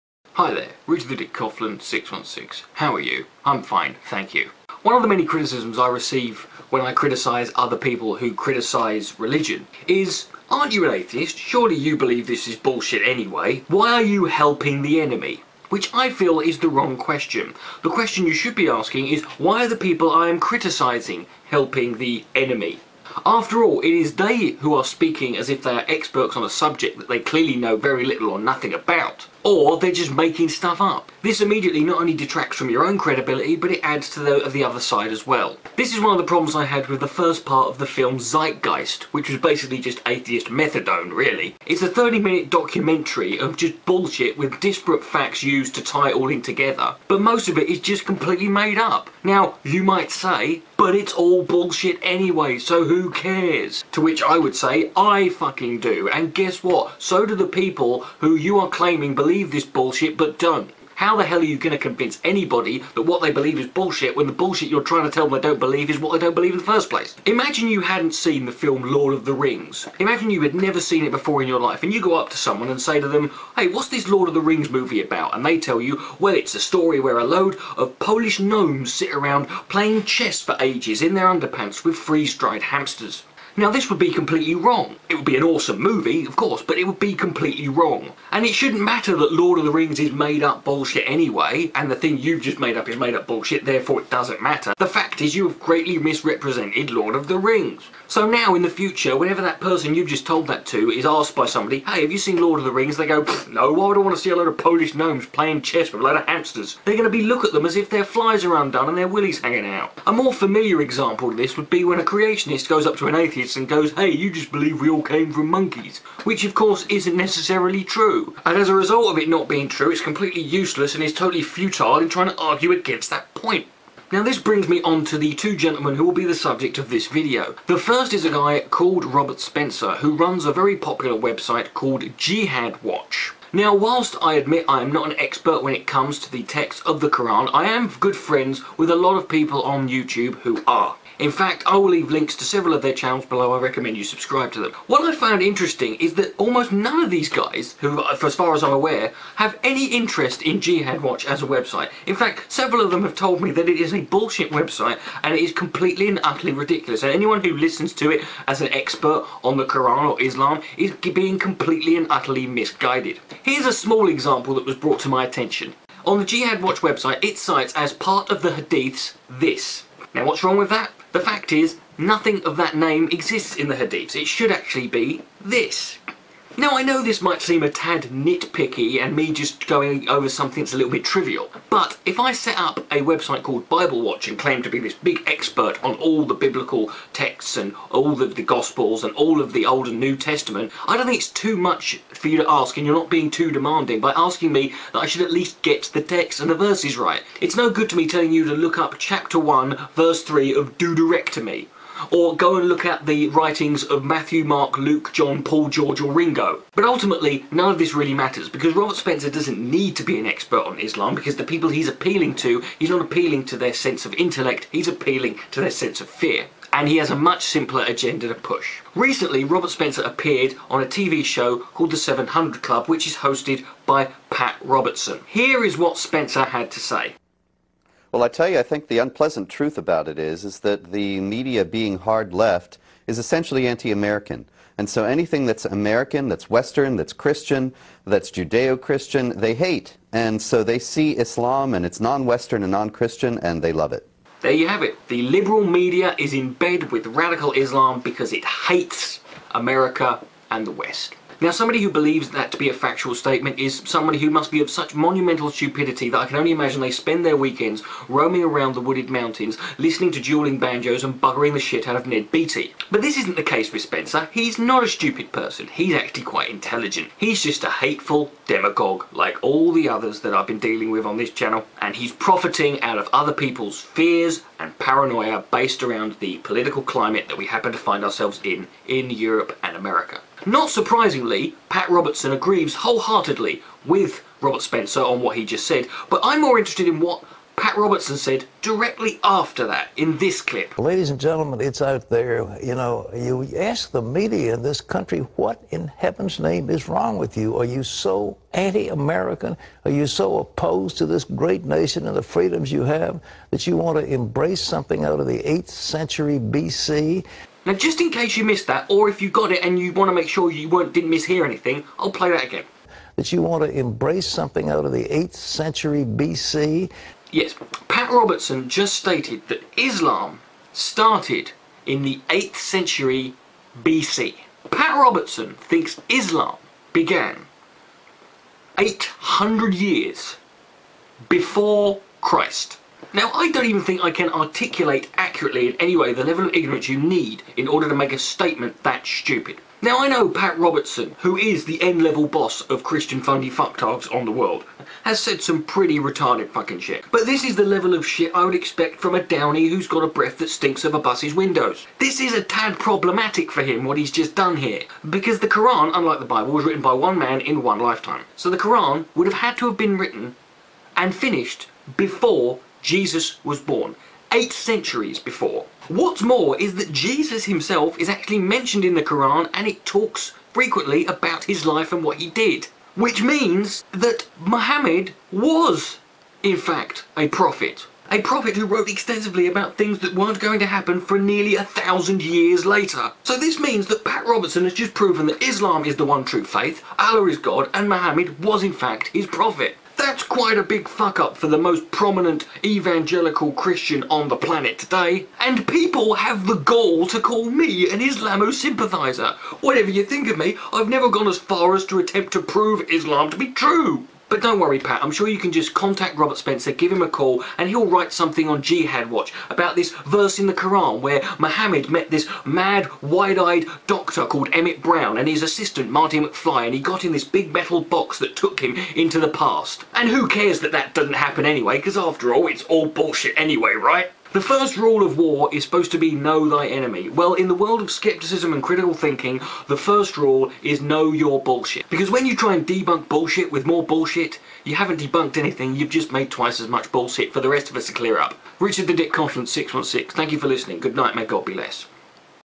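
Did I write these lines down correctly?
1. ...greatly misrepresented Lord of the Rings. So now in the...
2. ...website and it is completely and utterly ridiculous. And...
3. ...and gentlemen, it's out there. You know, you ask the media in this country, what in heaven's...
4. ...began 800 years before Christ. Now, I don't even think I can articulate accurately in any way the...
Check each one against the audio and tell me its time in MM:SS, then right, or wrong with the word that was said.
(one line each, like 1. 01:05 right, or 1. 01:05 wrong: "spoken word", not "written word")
1. 01:35 right
2. 02:34 right
3. 04:51 right
4. 05:26 right.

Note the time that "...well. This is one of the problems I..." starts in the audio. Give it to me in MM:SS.
00:35.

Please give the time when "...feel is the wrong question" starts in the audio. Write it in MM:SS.
00:16.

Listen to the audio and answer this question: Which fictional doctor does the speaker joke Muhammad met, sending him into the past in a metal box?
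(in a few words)
Emmett Brown.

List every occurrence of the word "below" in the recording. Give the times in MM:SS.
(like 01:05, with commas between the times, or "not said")
02:23.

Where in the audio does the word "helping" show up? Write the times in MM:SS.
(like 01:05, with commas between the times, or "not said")
00:14, 00:21.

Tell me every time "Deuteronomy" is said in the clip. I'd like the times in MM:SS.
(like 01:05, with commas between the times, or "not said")
03:20.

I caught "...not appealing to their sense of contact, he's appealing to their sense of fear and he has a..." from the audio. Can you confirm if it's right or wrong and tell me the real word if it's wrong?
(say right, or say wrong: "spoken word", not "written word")
wrong: "intellect", not "contact".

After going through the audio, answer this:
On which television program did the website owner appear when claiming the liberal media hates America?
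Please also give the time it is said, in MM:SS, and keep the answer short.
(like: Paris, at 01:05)
The 700 Club, at 03:41.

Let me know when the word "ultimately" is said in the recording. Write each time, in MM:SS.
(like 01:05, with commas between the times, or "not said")
03:26.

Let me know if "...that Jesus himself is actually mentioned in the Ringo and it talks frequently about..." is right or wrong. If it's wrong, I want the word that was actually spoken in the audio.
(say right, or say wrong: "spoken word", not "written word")
wrong: "Quran", not "Ringo".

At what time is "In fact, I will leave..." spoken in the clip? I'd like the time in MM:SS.
02:21.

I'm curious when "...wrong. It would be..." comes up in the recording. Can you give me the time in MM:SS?
01:24.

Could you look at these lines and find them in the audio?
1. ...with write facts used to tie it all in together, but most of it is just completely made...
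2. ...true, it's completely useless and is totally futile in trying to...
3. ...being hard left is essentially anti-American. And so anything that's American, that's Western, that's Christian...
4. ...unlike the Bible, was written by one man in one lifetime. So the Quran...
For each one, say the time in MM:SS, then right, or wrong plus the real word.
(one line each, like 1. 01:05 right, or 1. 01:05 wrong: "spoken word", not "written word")
1. 00:44 wrong: "disparate", not "write"
2. 01:59 right
3. 03:51 right
4. 05:55 right.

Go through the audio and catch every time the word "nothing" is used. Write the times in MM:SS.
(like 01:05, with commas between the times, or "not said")
00:28, 02:51.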